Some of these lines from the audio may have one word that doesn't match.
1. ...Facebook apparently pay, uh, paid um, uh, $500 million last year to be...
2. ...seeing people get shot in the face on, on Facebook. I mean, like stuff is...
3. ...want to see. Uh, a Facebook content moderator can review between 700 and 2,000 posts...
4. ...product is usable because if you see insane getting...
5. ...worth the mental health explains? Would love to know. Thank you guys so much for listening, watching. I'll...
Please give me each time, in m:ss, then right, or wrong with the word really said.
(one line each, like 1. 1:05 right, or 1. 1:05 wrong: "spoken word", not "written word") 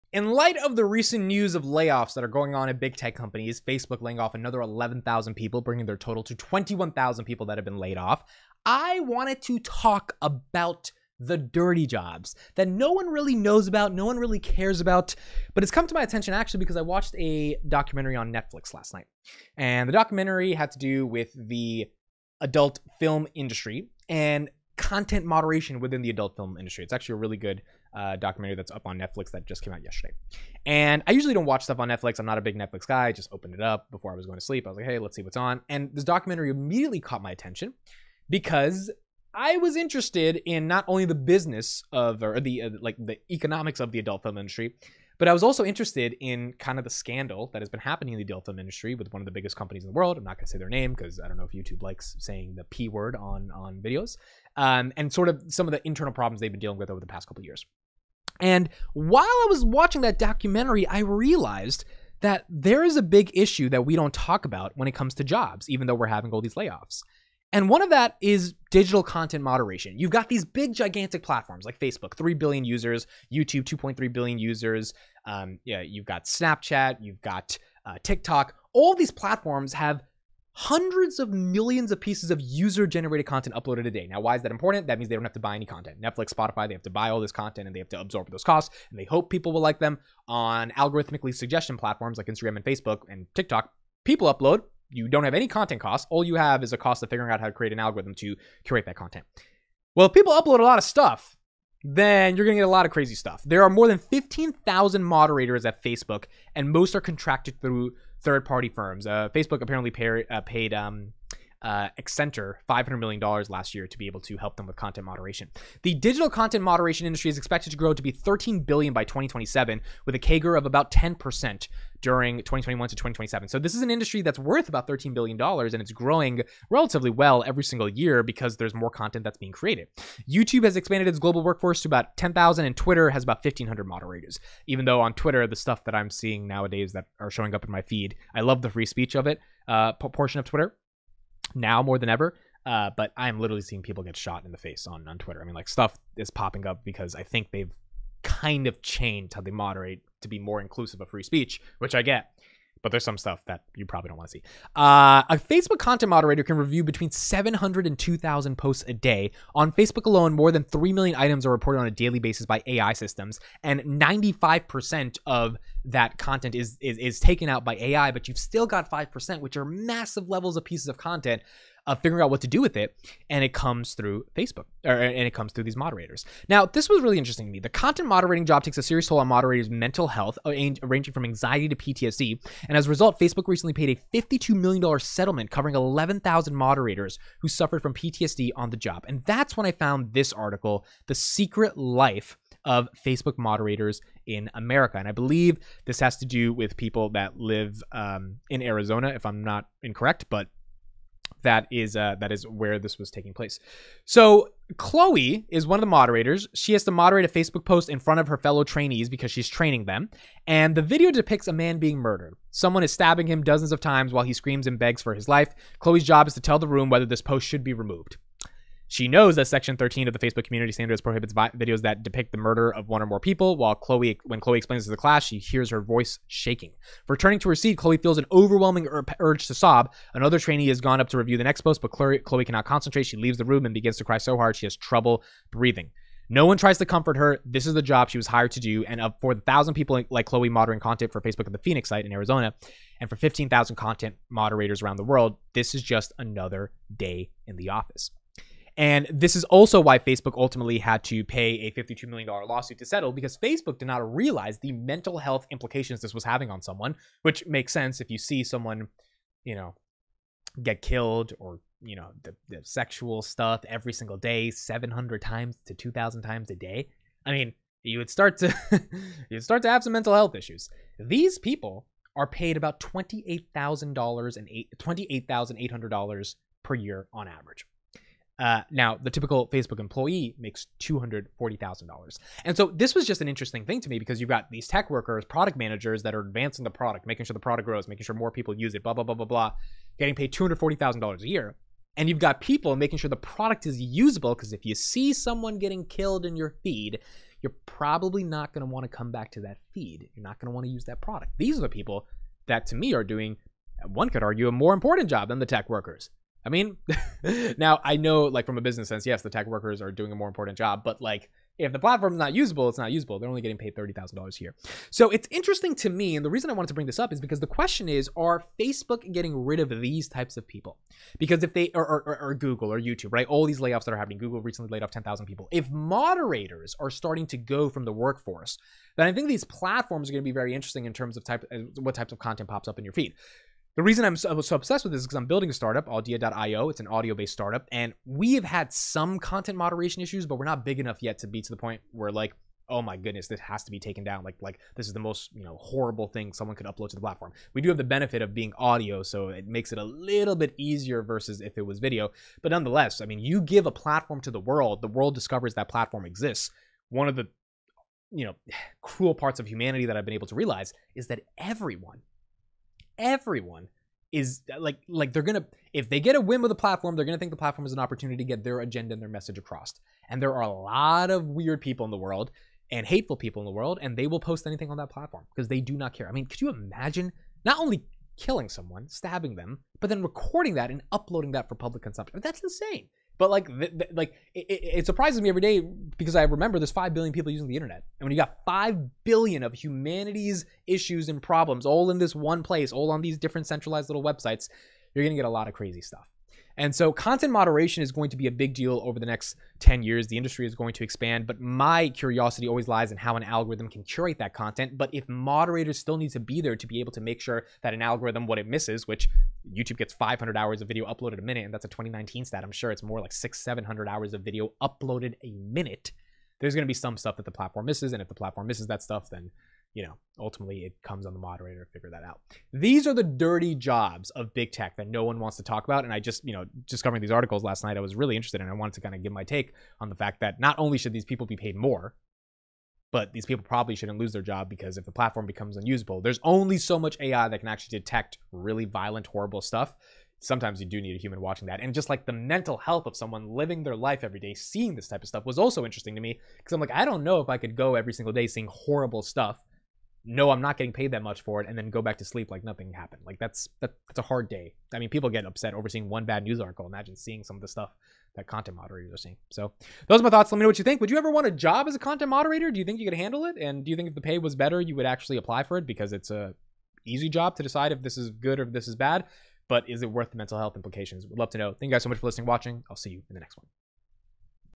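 1. 1:49 right
2. 2:23 wrong: "Twitter", not "Facebook"
3. 2:34 right
4. 4:53 wrong: "someone", not "insane"
5. 7:49 wrong: "implications", not "explains".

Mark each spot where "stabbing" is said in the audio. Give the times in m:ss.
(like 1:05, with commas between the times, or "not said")
3:32, 6:18.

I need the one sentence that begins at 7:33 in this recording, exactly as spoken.
Like that's that, that's a hard day.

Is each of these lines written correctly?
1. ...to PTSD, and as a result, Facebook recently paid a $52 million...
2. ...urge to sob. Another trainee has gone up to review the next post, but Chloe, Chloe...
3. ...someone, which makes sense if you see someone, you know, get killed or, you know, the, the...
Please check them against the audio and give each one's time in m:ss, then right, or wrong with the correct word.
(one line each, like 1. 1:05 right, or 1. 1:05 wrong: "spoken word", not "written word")
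1. 3:01 right
2. 3:49 right
3. 4:16 right.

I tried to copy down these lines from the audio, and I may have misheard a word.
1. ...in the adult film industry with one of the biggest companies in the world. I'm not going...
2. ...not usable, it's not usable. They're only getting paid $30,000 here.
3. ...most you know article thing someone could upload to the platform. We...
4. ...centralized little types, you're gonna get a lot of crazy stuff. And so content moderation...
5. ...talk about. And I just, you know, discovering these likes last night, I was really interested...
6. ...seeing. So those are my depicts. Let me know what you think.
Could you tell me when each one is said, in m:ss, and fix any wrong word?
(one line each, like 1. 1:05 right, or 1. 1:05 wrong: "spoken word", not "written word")
1. 0:48 right
2. 5:12 right
3. 5:44 wrong: "horrible", not "article"
4. 6:33 wrong: "websites", not "types"
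5. 7:05 wrong: "articles", not "likes"
6. 7:38 wrong: "thoughts", not "depicts".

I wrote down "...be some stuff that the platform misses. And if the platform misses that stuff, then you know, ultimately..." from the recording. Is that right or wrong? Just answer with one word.
right.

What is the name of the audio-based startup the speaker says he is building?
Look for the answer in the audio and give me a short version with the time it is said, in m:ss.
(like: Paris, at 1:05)
Audia.io, at 5:35.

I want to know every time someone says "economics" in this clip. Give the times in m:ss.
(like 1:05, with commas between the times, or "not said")
0:43.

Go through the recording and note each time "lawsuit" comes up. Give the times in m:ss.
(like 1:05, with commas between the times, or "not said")
4:12.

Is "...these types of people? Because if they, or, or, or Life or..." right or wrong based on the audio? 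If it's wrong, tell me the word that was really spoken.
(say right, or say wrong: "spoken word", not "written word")
wrong: "Google", not "Life".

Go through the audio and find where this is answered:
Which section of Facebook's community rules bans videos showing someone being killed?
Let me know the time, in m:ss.
3:39.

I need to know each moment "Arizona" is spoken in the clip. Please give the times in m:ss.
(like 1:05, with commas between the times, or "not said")
3:18, 4:02.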